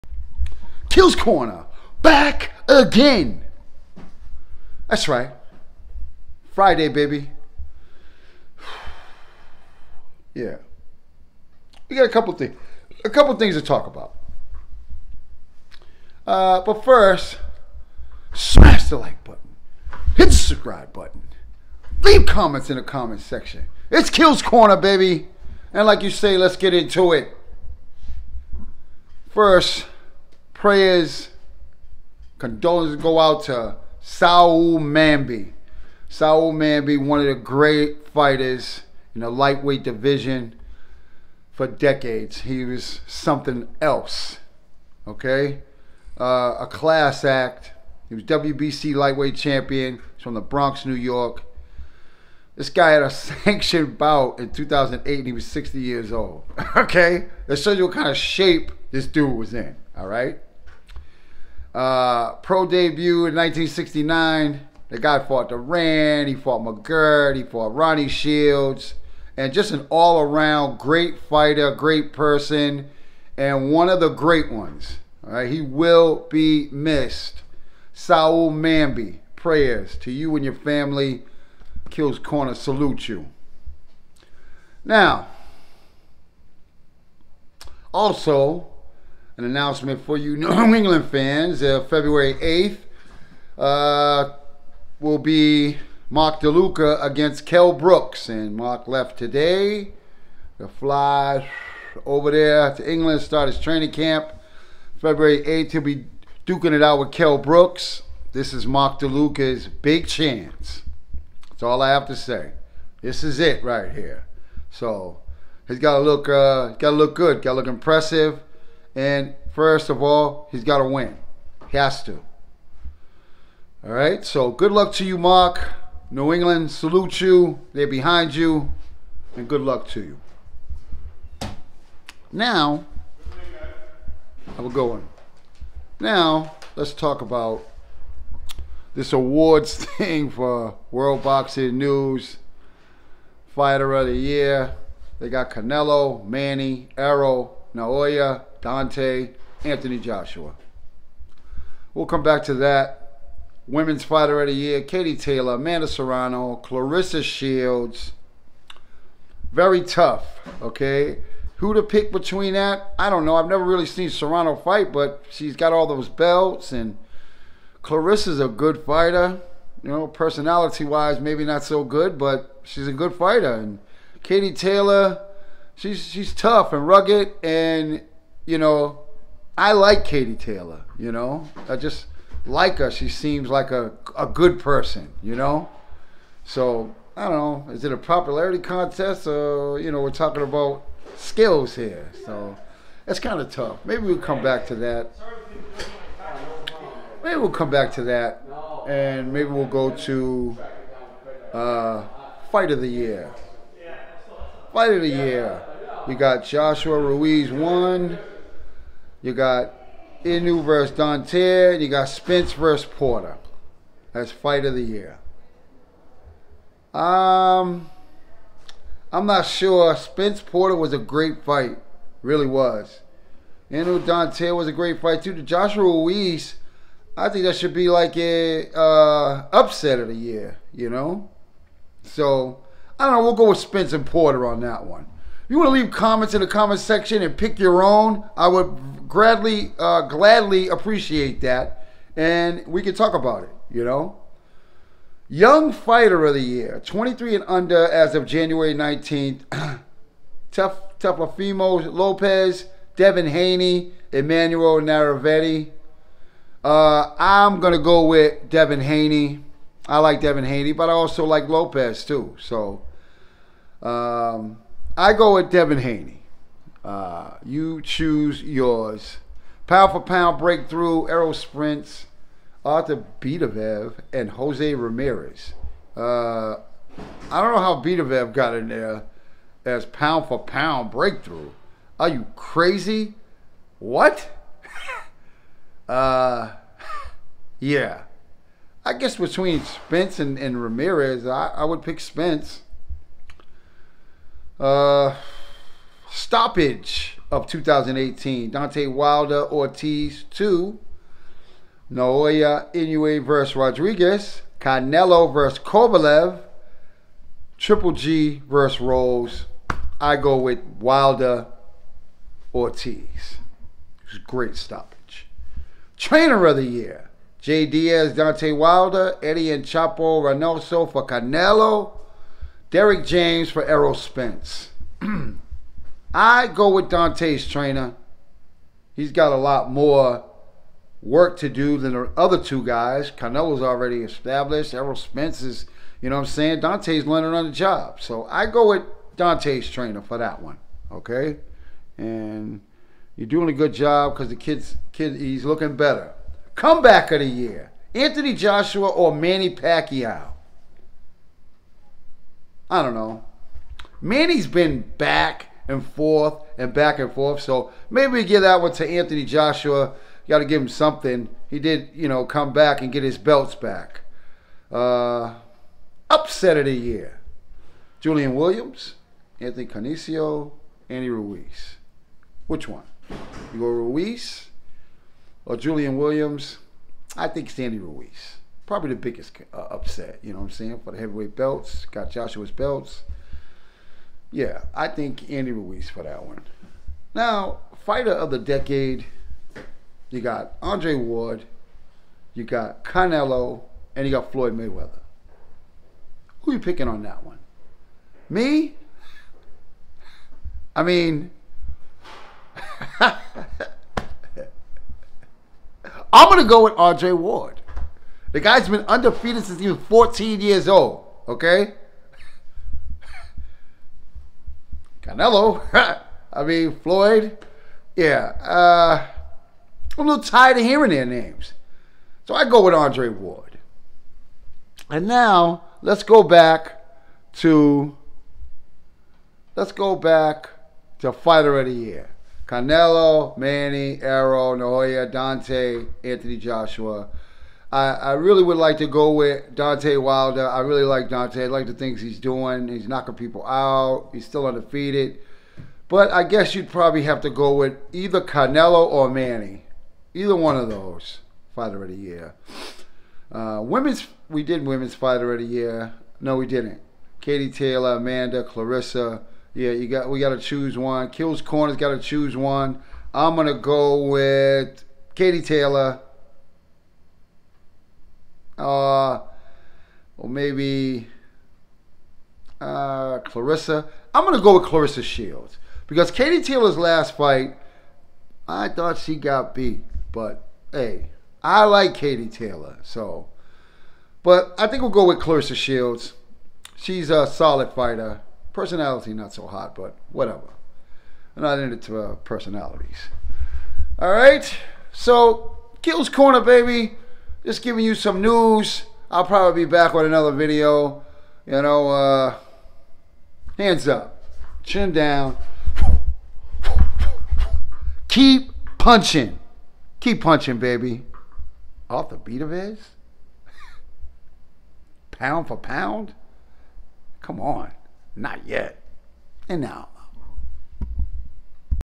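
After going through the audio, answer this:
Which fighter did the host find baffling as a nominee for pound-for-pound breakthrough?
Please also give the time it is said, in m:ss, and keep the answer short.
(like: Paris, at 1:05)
Artur Beterbiev, at 4:32.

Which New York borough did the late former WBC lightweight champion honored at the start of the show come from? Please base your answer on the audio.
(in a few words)
The Bronx.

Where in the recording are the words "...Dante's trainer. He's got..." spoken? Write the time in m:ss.
5:26.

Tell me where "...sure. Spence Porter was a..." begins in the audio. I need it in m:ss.
3:39.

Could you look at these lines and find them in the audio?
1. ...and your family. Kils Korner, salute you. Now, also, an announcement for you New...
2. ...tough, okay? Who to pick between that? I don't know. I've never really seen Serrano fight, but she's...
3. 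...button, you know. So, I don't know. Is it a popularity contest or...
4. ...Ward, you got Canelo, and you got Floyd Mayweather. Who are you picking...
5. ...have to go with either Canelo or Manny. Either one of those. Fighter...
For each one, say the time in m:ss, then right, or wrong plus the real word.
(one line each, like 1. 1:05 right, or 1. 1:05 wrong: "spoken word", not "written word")
1. 1:20 right
2. 2:39 right
3. 3:04 wrong: "person", not "button"
4. 6:30 right
5. 7:27 right.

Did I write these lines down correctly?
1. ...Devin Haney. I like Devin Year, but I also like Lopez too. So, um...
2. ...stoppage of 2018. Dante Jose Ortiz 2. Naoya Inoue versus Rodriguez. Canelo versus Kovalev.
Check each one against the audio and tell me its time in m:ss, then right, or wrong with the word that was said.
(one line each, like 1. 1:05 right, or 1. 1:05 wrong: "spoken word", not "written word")
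1. 4:18 wrong: "Haney", not "Year"
2. 4:56 wrong: "Wilder", not "Jose".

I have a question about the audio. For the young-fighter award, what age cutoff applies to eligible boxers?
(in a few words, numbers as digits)
23 and under.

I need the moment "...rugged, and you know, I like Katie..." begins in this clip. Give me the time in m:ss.
2:56.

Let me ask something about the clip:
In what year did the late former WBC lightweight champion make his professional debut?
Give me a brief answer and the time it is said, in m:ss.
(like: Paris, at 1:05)
1969, at 1:03.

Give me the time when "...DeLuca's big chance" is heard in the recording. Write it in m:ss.
1:48.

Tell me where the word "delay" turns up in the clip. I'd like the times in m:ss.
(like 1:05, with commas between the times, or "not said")
not said.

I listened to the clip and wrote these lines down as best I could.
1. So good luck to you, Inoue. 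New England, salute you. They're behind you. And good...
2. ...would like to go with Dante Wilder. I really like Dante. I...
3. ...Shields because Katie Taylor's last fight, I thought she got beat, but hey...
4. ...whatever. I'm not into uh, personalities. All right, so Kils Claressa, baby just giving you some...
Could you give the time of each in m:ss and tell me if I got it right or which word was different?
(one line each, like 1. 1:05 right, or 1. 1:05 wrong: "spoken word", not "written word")
1. 2:04 wrong: "Mark", not "Inoue"
2. 7:18 right
3. 7:55 right
4. 8:10 wrong: "Korner", not "Claressa".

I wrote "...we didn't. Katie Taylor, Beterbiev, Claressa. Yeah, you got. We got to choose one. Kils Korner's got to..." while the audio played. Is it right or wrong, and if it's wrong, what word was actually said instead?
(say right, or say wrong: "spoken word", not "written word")
wrong: "Amanda", not "Beterbiev".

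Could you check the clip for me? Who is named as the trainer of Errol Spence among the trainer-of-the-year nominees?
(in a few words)
Derek James.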